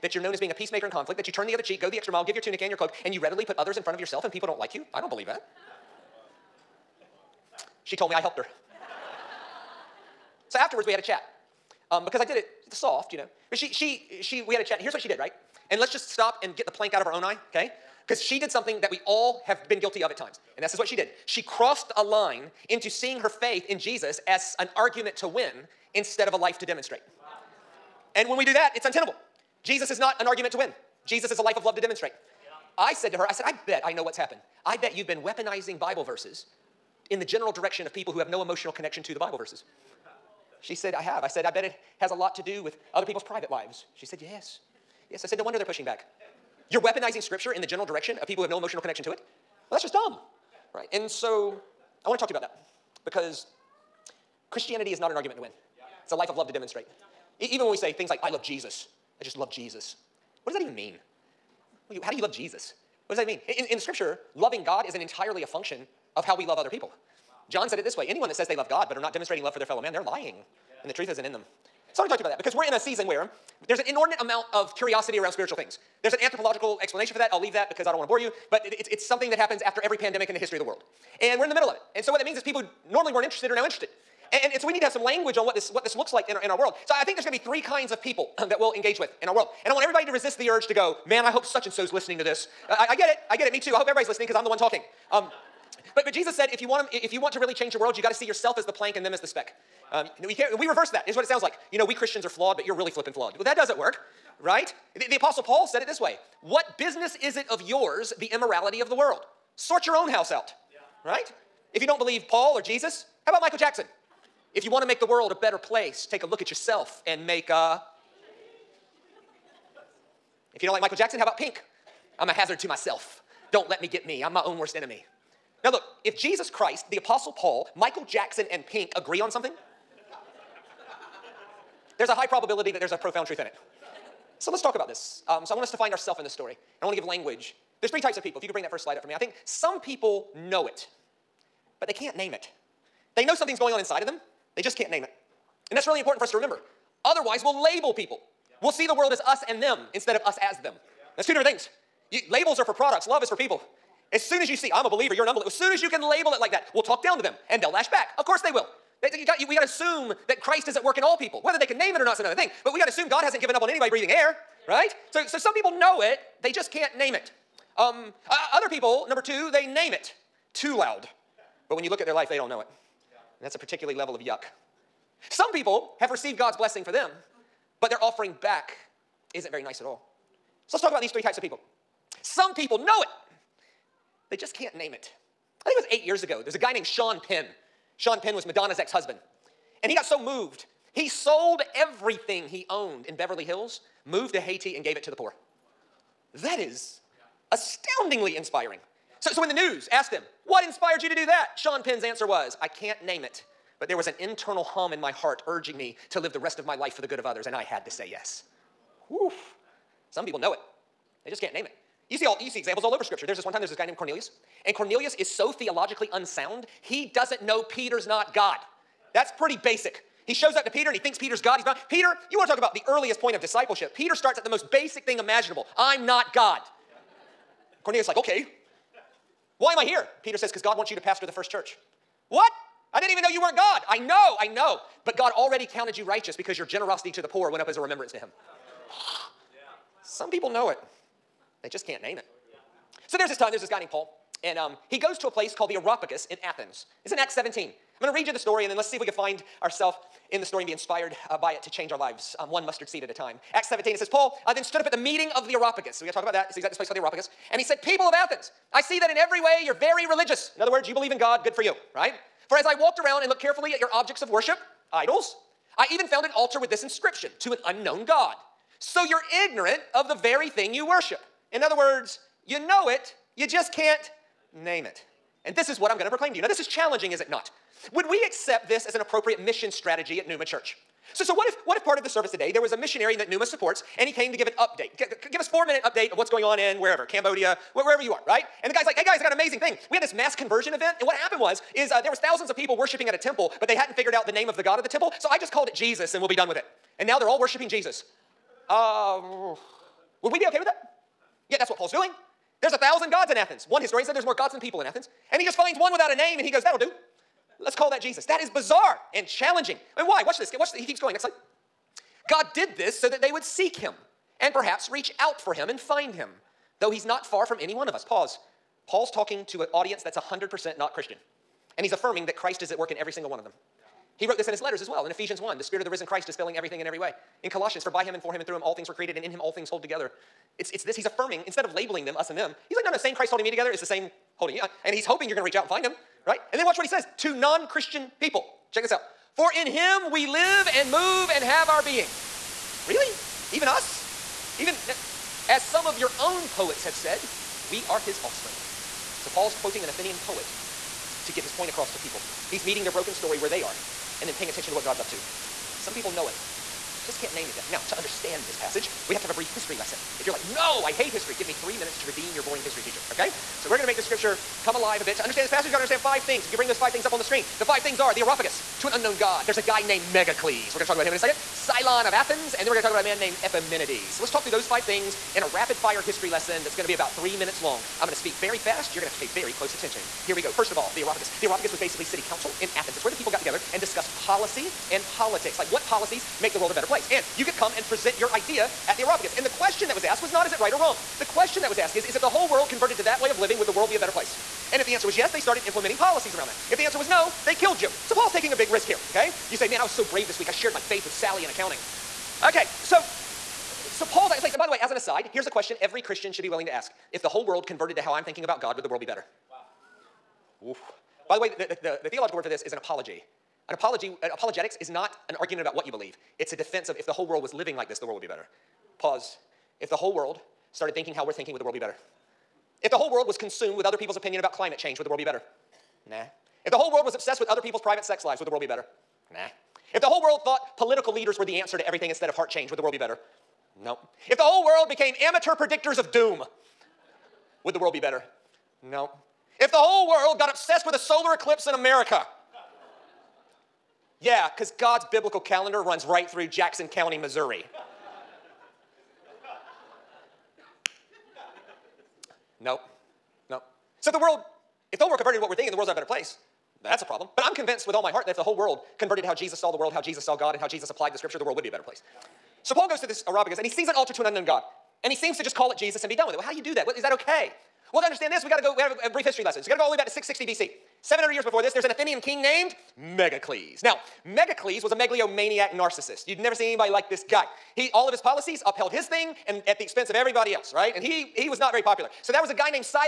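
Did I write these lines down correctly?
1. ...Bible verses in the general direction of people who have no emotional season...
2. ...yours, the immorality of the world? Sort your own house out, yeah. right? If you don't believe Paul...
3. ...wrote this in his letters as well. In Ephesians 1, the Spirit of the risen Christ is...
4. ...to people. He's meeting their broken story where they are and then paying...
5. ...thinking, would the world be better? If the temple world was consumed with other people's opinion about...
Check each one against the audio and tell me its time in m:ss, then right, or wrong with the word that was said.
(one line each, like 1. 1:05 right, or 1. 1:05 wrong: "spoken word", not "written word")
1. 0:35 wrong: "connection", not "season"
2. 1:47 right
3. 5:24 right
4. 5:51 right
5. 7:01 wrong: "whole", not "temple".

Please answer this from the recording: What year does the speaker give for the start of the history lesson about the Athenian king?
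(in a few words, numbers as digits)
660 BC.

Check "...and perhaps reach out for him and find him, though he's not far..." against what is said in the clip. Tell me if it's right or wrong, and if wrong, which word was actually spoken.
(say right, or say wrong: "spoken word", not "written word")
right.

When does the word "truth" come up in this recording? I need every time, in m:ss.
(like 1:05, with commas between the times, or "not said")
1:10, 2:13.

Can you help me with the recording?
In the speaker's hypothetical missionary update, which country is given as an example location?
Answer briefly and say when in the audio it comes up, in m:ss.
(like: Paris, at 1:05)
Cambodia, at 4:47.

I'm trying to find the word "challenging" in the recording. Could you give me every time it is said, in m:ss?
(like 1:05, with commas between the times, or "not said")
4:36, 5:09.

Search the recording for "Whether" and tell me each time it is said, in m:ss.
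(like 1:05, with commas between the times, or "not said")
2:41.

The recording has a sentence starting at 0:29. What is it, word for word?
Jesus is not an argument to win.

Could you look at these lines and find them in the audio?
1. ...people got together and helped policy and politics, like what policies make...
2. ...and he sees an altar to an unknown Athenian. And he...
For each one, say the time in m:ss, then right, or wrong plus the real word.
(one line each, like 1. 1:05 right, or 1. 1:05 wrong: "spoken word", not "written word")
1. 6:23 wrong: "discussed", not "helped"
2. 7:43 wrong: "God", not "Athenian".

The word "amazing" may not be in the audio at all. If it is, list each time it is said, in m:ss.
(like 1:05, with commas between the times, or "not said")
4:49.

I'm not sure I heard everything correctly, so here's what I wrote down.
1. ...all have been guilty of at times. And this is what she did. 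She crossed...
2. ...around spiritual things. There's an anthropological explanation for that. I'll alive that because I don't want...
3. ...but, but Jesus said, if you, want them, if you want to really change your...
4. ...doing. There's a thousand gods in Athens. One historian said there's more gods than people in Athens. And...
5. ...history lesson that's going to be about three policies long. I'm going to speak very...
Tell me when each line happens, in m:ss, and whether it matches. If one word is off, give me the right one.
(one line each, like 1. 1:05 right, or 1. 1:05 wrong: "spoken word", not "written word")
1. 0:19 right
2. 1:15 wrong: "leave", not "alive"
3. 1:35 right
4. 5:01 right
5. 6:15 wrong: "minutes", not "policies".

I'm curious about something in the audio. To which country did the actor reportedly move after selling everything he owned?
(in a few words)
Haiti.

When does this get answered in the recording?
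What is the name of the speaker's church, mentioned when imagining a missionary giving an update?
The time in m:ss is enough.
4:40.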